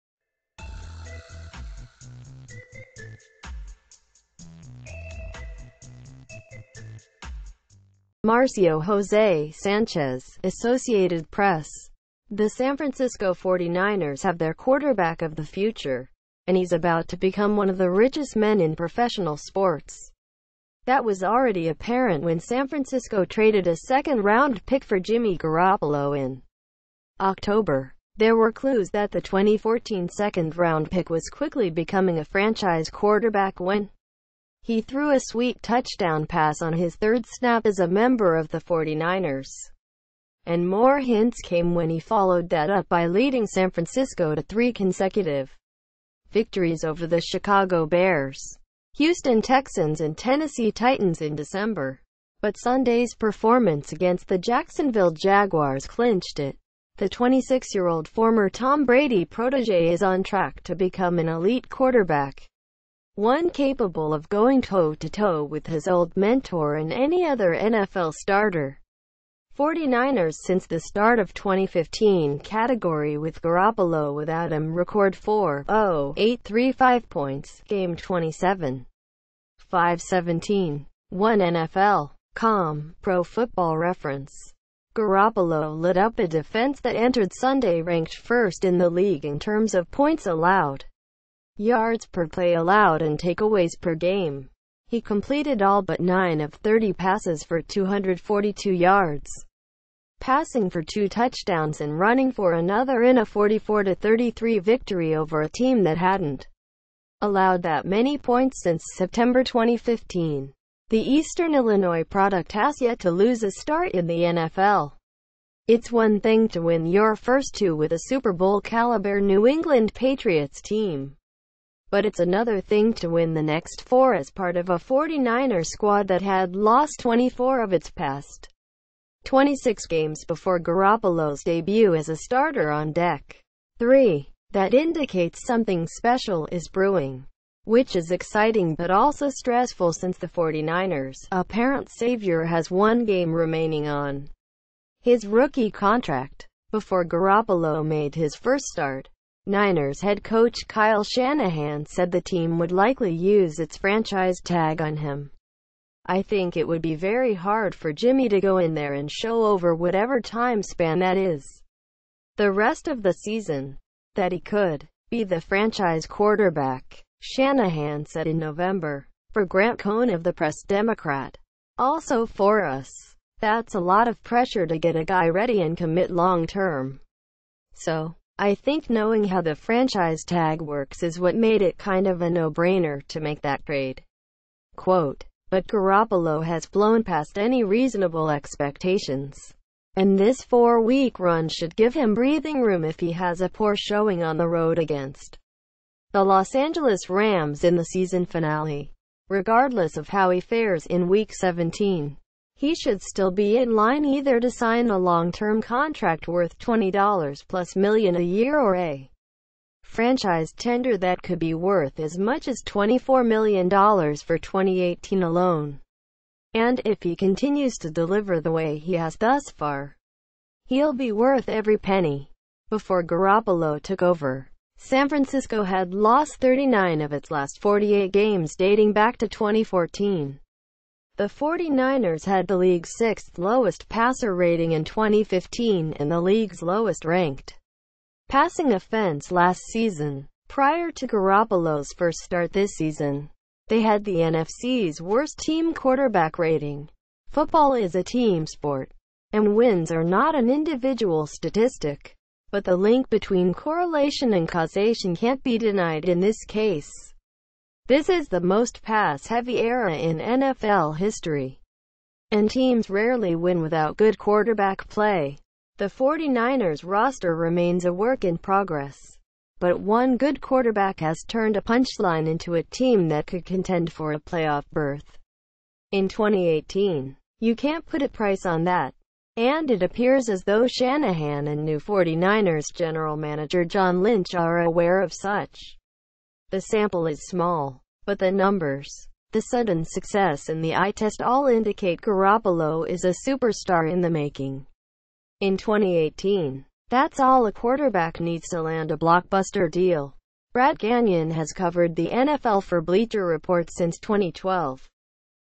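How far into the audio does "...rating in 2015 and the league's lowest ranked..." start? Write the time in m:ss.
3:54.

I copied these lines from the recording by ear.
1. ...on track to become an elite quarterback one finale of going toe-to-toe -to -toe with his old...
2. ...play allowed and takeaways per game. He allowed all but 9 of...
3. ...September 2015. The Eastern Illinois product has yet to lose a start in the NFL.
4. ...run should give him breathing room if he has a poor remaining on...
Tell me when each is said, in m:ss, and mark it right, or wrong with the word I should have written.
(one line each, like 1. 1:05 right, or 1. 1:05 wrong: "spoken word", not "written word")
1. 1:00 wrong: "capable", not "finale"
2. 1:32 wrong: "completed", not "allowed"
3. 1:48 right
4. 3:11 wrong: "showing", not "remaining".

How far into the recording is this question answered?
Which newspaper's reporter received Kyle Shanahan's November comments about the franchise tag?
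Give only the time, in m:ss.
2:50.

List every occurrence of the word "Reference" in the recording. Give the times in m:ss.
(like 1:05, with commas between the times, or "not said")
1:23.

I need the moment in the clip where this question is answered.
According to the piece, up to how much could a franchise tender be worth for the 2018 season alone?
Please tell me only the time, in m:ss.
3:32.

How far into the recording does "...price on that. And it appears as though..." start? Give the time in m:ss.
4:38.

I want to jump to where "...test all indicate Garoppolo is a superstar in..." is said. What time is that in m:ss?
4:50.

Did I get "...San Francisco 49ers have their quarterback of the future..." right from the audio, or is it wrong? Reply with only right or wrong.
right.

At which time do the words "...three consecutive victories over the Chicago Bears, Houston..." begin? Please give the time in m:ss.
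0:44.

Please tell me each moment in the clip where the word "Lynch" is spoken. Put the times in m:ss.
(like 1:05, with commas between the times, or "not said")
4:44.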